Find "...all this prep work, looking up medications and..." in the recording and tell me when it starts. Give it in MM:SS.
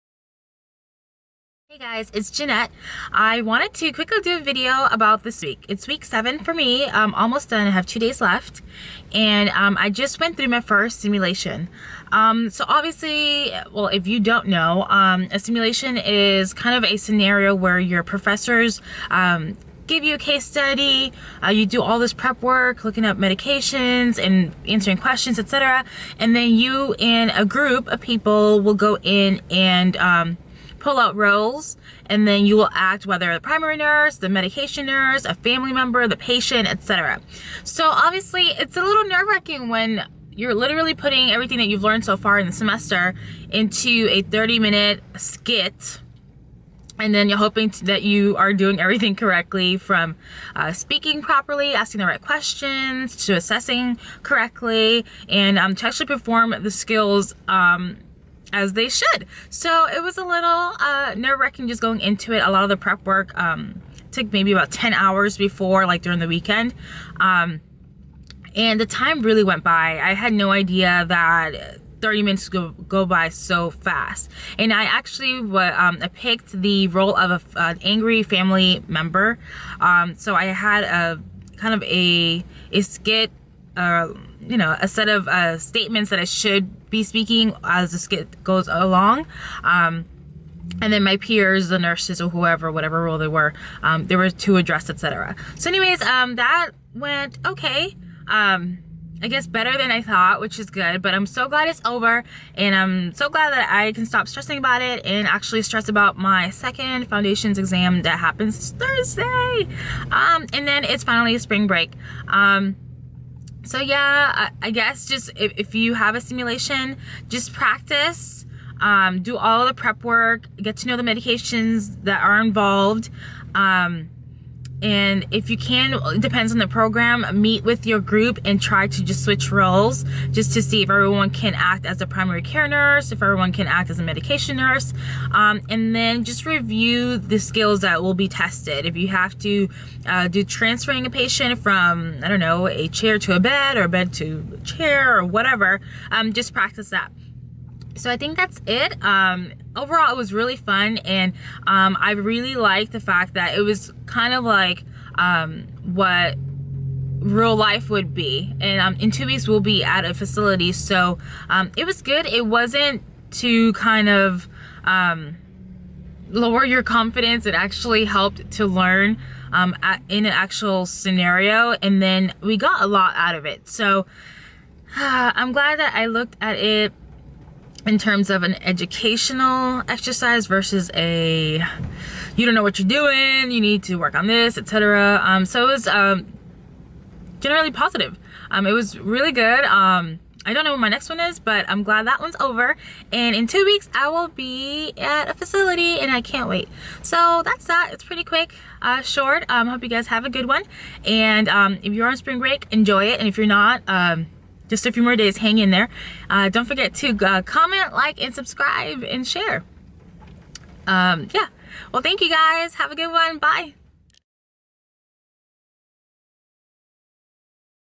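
00:21.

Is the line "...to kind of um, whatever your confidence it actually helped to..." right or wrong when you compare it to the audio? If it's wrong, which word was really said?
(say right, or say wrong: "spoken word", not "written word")
wrong: "lower", not "whatever".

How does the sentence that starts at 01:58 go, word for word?
Um, do all the prep work, get to know the medications that are involved.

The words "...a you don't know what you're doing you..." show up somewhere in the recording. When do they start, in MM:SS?
03:00.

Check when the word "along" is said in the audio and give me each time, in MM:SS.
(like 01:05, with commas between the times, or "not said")
01:28.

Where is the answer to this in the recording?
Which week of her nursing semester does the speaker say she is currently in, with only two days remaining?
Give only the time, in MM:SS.
00:05.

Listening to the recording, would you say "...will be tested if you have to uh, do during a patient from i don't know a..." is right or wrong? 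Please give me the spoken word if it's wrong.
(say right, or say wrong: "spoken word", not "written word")
wrong: "transferring", not "during".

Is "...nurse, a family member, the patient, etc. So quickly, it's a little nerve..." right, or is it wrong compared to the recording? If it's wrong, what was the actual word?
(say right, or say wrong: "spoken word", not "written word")
wrong: "obviously", not "quickly".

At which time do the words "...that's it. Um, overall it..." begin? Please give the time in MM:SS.
02:28.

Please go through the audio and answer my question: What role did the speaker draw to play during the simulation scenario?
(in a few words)
Angry family member.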